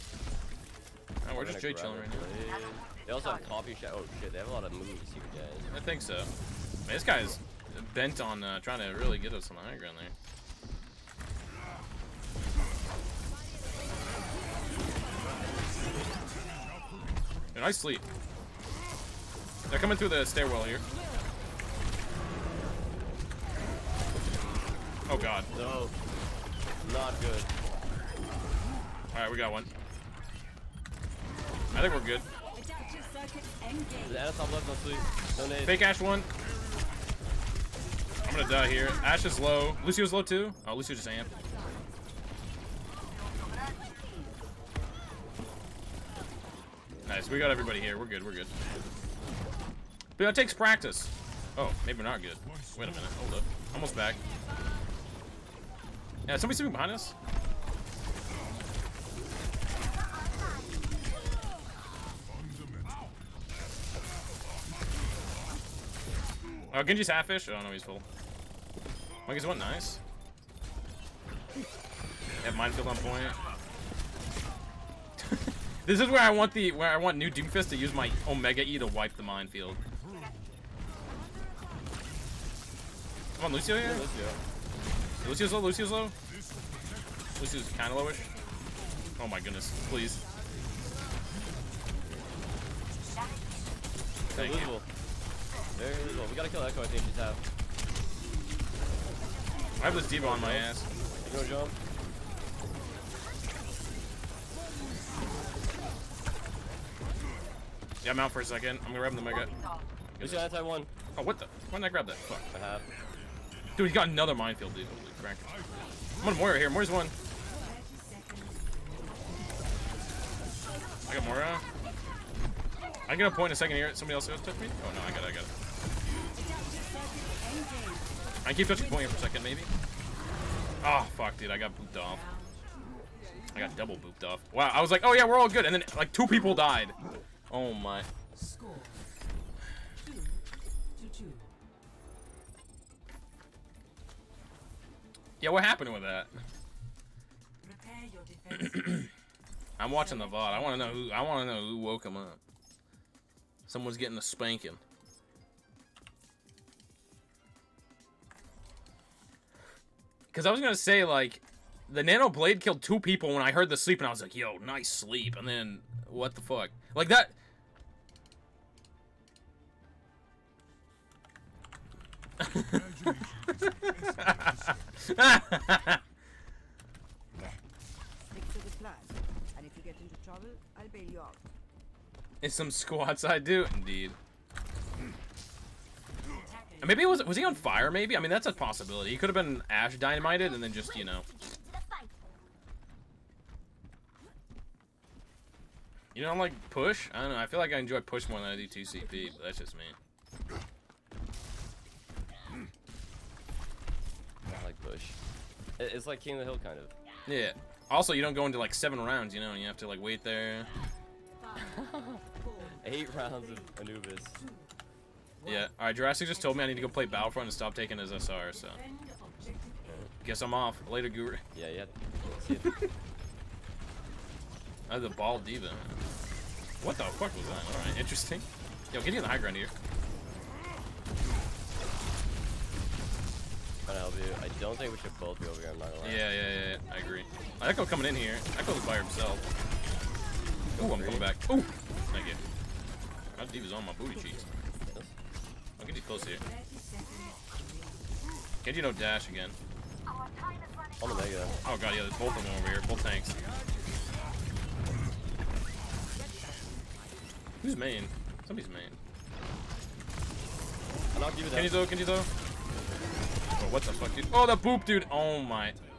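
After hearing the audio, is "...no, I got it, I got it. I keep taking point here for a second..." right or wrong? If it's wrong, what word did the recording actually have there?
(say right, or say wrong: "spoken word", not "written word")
wrong: "touching", not "taking".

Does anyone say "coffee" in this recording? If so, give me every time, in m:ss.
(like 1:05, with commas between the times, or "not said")
0:03.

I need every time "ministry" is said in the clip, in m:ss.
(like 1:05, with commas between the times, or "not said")
not said.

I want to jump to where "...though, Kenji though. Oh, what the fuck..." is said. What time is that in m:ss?
4:21.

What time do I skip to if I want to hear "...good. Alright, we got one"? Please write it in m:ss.
0:27.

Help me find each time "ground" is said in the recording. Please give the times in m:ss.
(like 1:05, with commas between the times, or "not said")
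0:09, 3:49.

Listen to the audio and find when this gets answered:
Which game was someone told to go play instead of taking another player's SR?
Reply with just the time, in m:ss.
3:37.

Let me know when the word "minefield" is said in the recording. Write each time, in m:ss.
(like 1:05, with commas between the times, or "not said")
1:12, 1:19, 1:54.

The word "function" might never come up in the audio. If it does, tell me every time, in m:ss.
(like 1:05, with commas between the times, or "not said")
not said.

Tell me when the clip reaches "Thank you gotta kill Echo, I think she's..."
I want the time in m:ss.
1:34.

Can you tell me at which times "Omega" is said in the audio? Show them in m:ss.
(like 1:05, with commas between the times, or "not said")
1:18.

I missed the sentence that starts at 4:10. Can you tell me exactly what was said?
Oh, they, uh, oh god, yeah, there's both of them over here.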